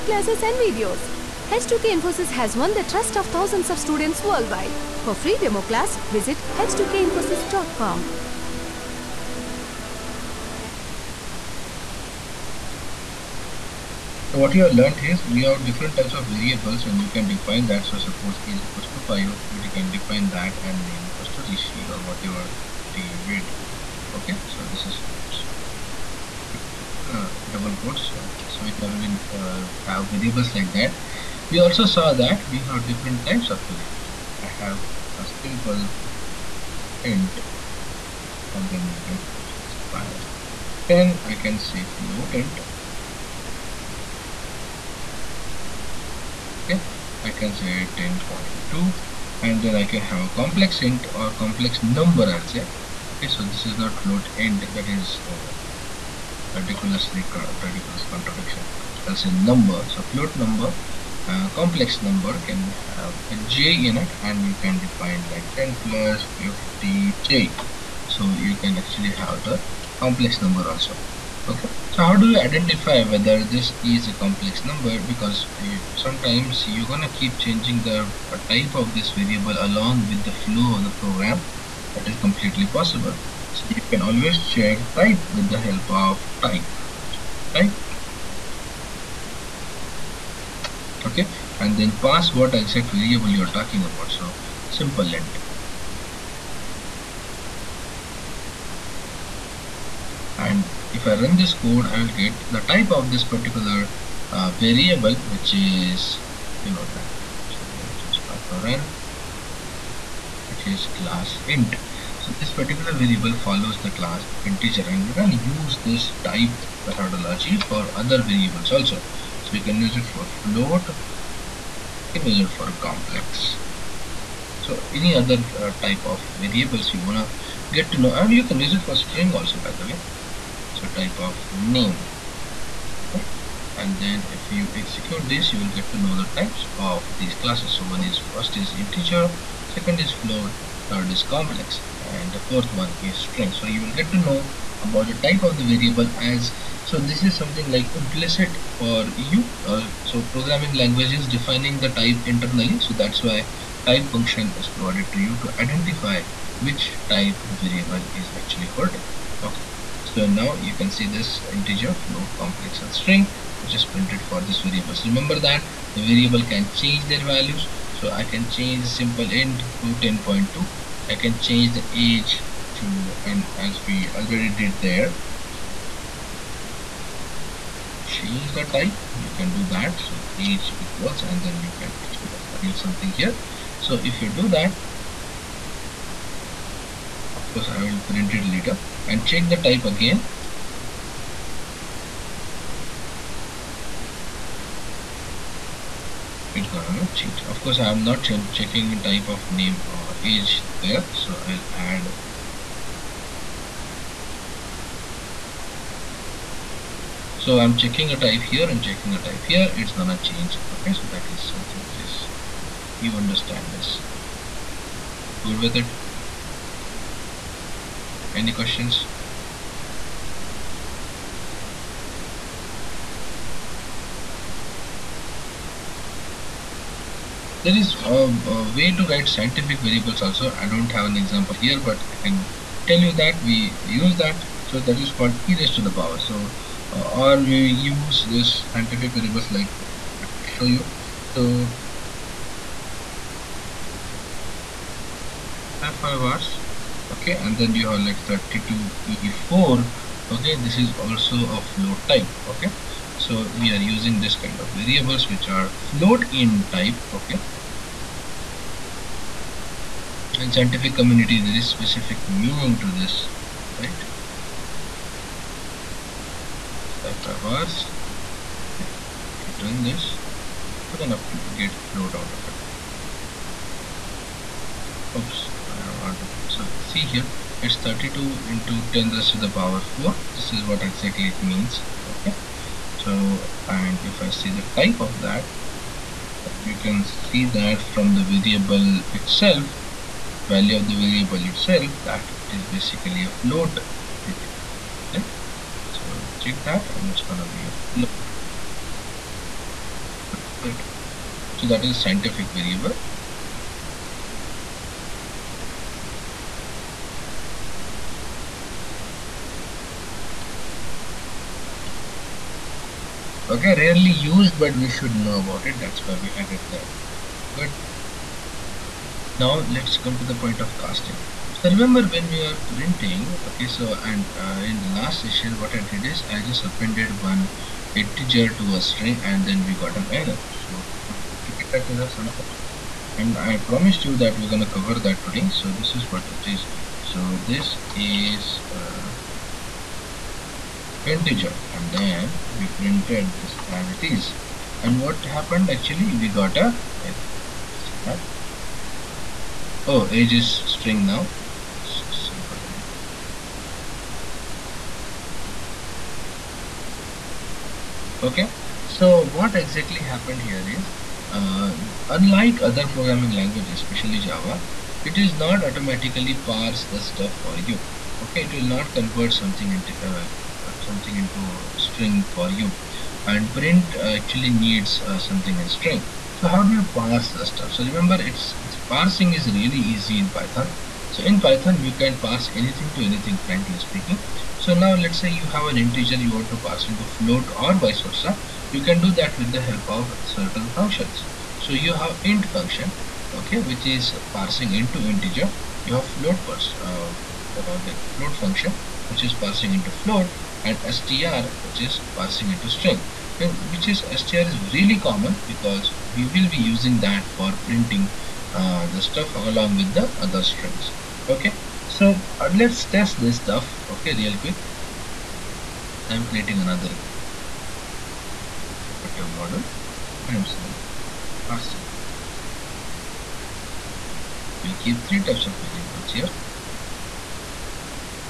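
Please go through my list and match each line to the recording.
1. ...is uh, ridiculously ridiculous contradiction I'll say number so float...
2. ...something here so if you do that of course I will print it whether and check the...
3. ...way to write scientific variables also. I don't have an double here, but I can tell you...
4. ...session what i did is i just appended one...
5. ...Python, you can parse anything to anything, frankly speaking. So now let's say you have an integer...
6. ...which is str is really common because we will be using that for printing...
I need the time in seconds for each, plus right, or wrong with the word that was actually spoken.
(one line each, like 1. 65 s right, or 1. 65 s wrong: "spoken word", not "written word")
1. 54 s right
2. 182 s wrong: "later", not "whether"
3. 228 s wrong: "example", not "double"
4. 325 s right
5. 381 s right
6. 403 s right.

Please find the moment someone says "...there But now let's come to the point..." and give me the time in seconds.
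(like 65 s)
316 s.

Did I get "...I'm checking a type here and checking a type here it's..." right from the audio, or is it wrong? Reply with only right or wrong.
right.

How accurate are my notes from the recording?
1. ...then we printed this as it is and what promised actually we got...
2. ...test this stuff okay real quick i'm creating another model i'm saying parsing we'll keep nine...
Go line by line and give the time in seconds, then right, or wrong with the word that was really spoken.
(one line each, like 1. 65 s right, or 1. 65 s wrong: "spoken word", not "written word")
1. 341 s wrong: "happened", not "promised"
2. 412 s wrong: "three", not "nine".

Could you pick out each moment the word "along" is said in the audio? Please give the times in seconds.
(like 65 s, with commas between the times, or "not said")
79 s, 409 s.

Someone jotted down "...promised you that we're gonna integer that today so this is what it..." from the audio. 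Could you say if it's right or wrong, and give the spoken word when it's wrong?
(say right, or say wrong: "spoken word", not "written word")
wrong: "cover", not "integer".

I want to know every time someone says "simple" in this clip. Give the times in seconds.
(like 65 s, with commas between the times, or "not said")
35 s, 94 s, 168 s, 352 s.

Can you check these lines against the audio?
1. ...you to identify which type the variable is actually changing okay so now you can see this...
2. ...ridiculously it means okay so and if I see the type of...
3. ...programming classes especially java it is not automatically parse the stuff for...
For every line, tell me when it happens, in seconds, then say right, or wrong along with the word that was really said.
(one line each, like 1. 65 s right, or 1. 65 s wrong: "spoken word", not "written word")
1. 155 s wrong: "holding", not "changing"
2. 280 s wrong: "exactly", not "ridiculously"
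3. 362 s wrong: "languages", not "classes".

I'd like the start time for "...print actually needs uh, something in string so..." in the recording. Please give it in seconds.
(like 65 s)
373 s.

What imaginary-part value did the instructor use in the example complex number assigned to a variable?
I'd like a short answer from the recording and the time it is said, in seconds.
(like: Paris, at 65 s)
50j, at 66 s.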